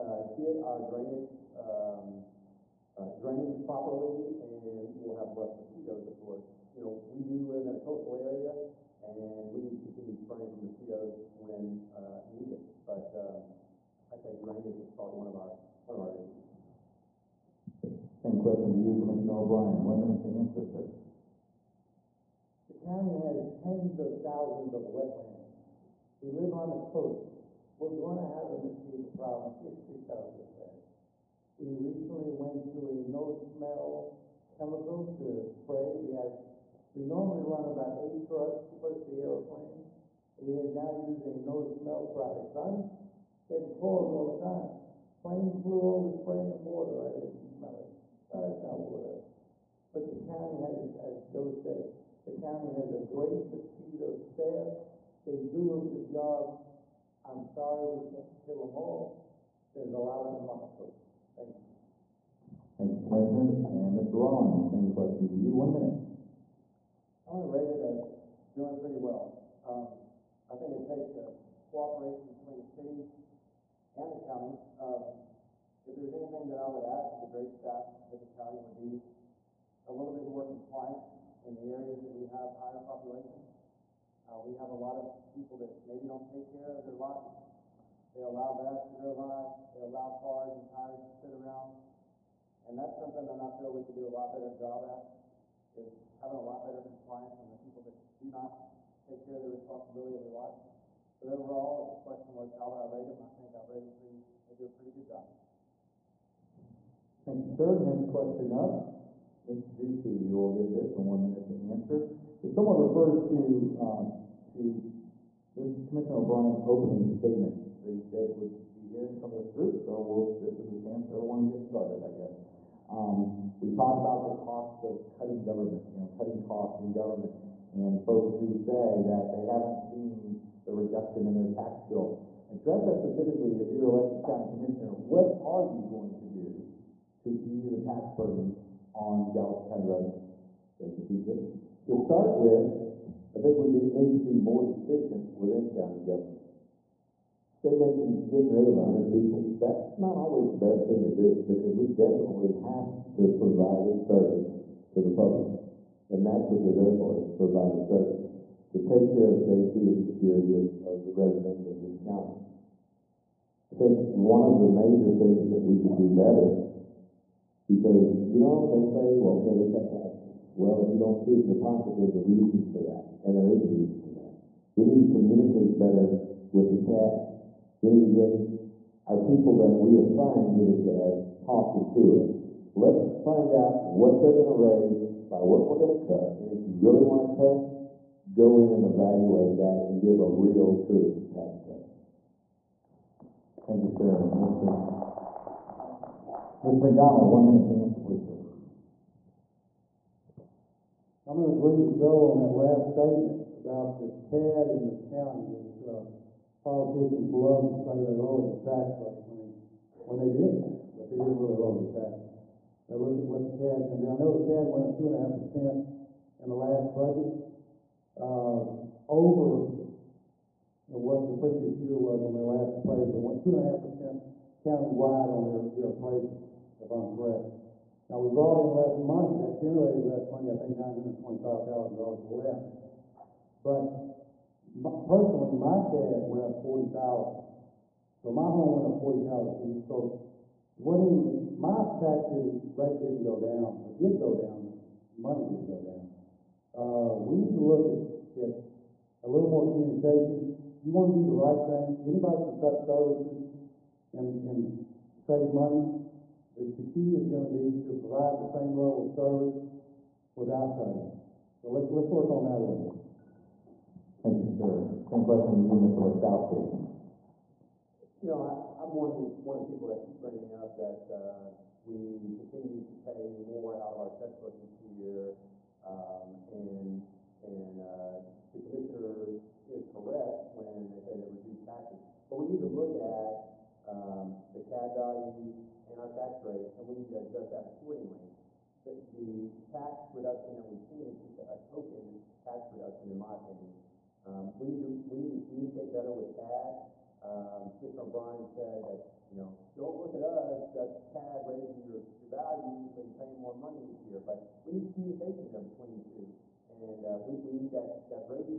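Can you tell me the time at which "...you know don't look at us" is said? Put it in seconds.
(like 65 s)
299 s.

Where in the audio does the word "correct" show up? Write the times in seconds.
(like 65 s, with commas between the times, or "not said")
227 s, 279 s.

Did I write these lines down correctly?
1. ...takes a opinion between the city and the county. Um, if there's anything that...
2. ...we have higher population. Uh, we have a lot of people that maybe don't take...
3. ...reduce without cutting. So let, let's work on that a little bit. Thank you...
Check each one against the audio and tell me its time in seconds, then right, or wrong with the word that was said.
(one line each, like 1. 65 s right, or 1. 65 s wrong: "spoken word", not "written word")
1. 70 s wrong: "cooperation", not "opinion"
2. 82 s right
3. 259 s wrong: "service", not "reduce".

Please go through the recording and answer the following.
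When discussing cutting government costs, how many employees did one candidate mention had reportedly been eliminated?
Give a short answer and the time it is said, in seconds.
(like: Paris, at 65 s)
100, at 148 s.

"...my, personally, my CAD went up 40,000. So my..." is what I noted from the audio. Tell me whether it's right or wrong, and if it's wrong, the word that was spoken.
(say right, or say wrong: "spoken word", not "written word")
right.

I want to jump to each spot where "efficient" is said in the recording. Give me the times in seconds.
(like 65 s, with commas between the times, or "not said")
144 s.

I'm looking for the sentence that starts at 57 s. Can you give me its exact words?
I'm sorry we can't kill them all.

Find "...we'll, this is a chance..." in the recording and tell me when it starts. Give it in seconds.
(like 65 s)
120 s.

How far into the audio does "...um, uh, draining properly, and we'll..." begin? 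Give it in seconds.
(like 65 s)
1 s.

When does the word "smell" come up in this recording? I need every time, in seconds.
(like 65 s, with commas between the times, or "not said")
33 s, 41 s, 47 s.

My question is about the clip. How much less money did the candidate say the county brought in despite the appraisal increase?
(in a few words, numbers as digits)
$925,000.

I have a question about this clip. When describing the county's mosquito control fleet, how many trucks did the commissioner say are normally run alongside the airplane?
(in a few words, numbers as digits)
8.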